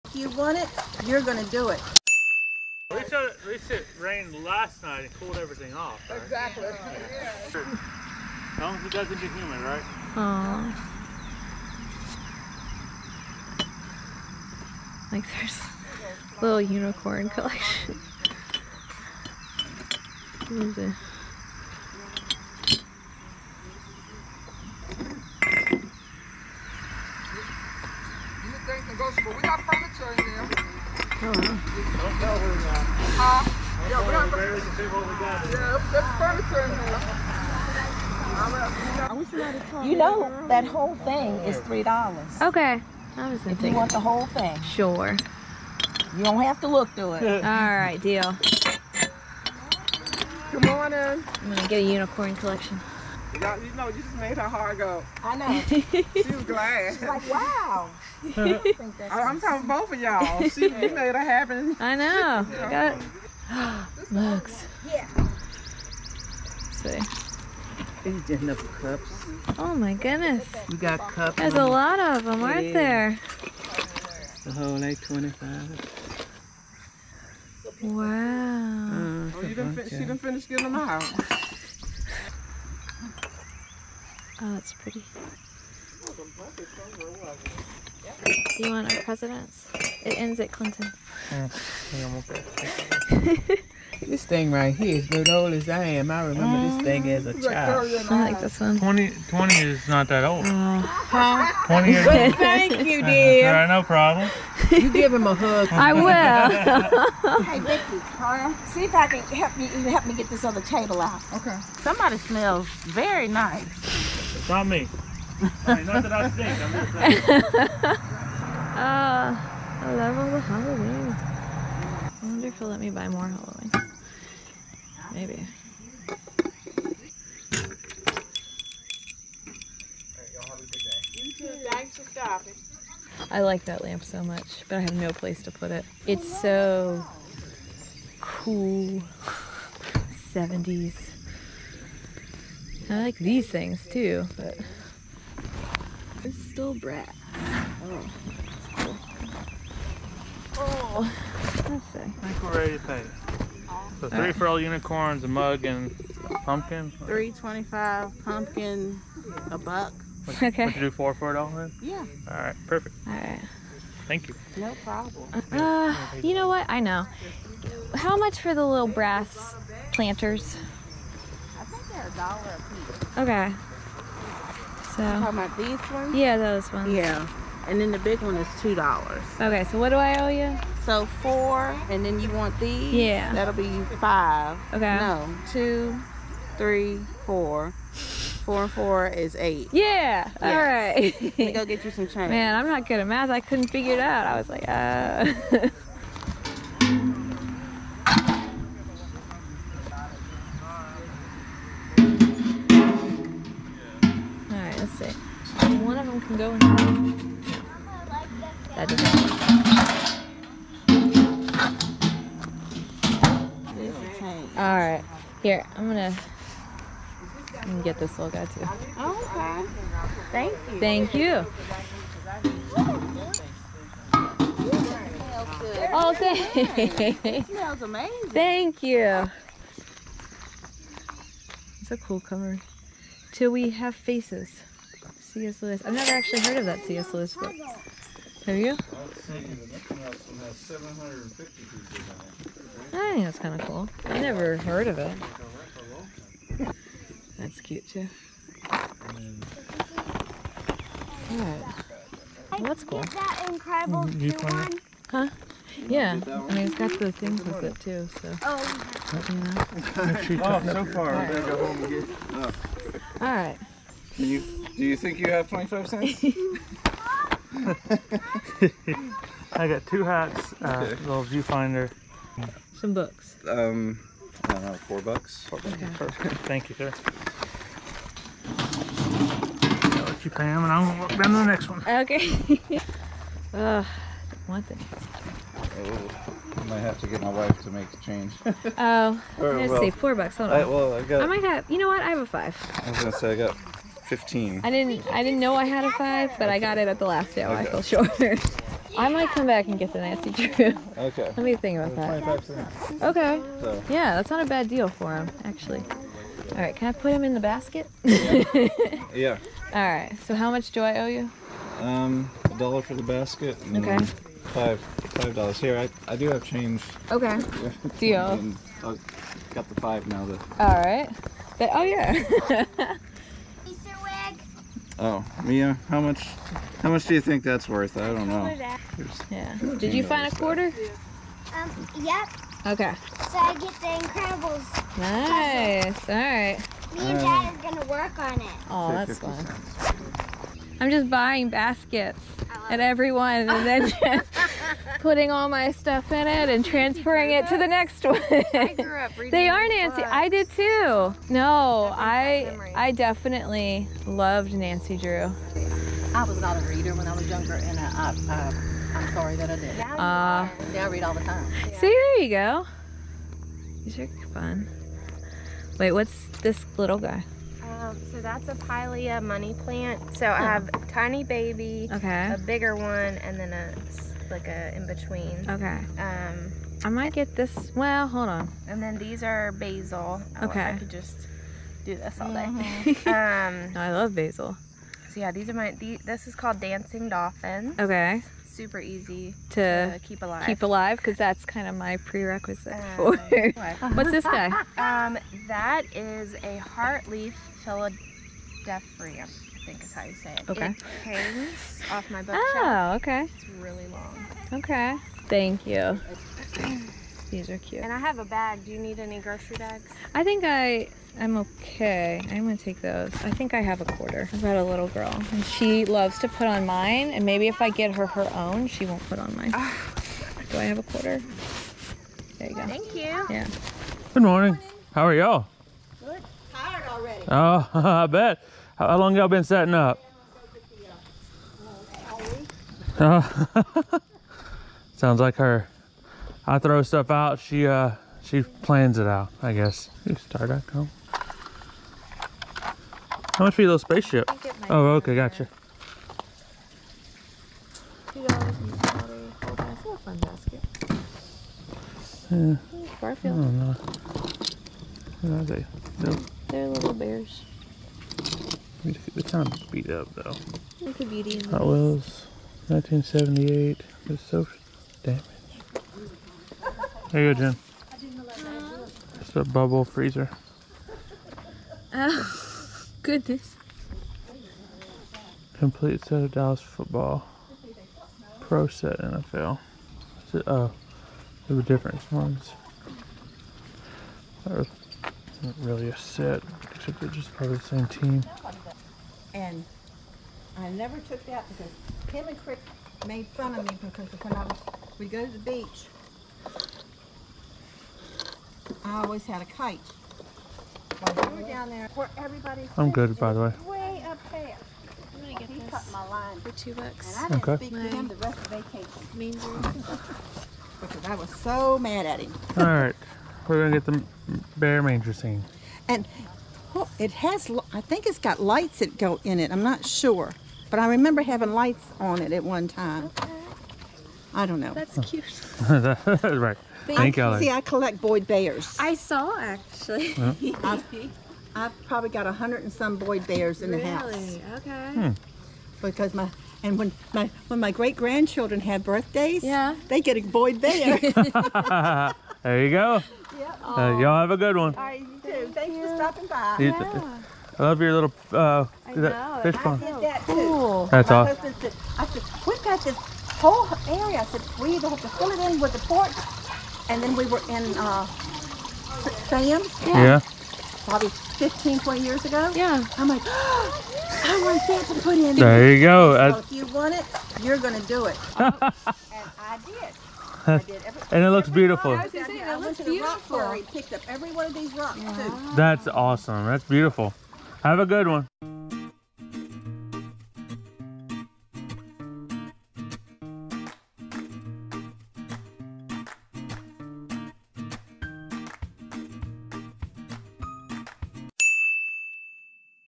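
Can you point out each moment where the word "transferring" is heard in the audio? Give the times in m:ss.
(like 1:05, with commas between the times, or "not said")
5:46.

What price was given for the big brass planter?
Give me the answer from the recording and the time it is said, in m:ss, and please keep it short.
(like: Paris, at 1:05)
$2, at 2:58.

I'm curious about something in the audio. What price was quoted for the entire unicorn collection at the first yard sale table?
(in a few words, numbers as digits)
$3.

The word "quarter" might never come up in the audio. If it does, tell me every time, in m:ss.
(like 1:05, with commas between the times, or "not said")
5:30, 6:53, 7:00.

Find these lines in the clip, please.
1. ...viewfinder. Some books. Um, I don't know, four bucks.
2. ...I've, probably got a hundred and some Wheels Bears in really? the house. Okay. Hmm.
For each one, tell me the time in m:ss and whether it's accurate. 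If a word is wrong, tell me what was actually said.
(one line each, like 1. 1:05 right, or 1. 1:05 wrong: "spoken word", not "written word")
1. 4:31 right
2. 8:51 wrong: "Boyd", not "Wheels".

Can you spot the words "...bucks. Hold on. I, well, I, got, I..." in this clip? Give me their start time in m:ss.
4:50.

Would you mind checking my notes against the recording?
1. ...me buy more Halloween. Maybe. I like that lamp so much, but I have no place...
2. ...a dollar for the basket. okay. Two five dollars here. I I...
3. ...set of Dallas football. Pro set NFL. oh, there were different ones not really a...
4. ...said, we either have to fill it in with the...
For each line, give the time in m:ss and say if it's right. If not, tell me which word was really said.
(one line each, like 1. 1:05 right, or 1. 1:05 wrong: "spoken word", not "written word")
1. 2:02 right
2. 5:12 wrong: "Five", not "Two"
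3. 7:56 right
4. 9:14 right.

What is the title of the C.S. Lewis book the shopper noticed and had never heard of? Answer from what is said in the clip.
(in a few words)
Till We Have Faces.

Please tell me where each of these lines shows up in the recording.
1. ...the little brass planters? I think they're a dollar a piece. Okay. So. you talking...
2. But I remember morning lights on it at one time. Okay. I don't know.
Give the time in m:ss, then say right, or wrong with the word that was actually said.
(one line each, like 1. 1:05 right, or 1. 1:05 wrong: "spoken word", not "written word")
1. 2:48 right
2. 8:40 wrong: "having", not "morning".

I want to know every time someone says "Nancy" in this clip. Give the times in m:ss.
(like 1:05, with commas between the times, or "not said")
5:00, 5:49, 5:54.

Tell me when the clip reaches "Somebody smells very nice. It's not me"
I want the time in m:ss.
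1:51.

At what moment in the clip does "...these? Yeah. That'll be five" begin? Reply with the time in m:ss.
3:02.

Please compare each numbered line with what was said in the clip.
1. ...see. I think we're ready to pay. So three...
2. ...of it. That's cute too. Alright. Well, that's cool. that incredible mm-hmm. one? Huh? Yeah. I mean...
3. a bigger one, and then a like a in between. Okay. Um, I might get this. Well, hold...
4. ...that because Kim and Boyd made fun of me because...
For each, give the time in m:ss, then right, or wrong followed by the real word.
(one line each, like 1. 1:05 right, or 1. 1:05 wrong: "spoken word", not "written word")
1. 2:31 right
2. 4:04 right
3. 6:12 right
4. 8:11 wrong: "Crick", not "Boyd".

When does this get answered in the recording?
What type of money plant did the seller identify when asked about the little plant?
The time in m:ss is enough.
6:08.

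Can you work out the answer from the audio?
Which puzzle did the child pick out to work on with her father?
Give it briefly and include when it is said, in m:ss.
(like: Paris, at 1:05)
Incredibles, at 5:34.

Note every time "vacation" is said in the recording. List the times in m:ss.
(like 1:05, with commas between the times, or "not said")
8:28.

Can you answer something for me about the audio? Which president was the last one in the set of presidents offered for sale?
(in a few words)
Clinton.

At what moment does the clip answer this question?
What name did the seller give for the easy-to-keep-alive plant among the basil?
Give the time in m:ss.
6:26.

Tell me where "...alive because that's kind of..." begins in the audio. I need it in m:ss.
6:30.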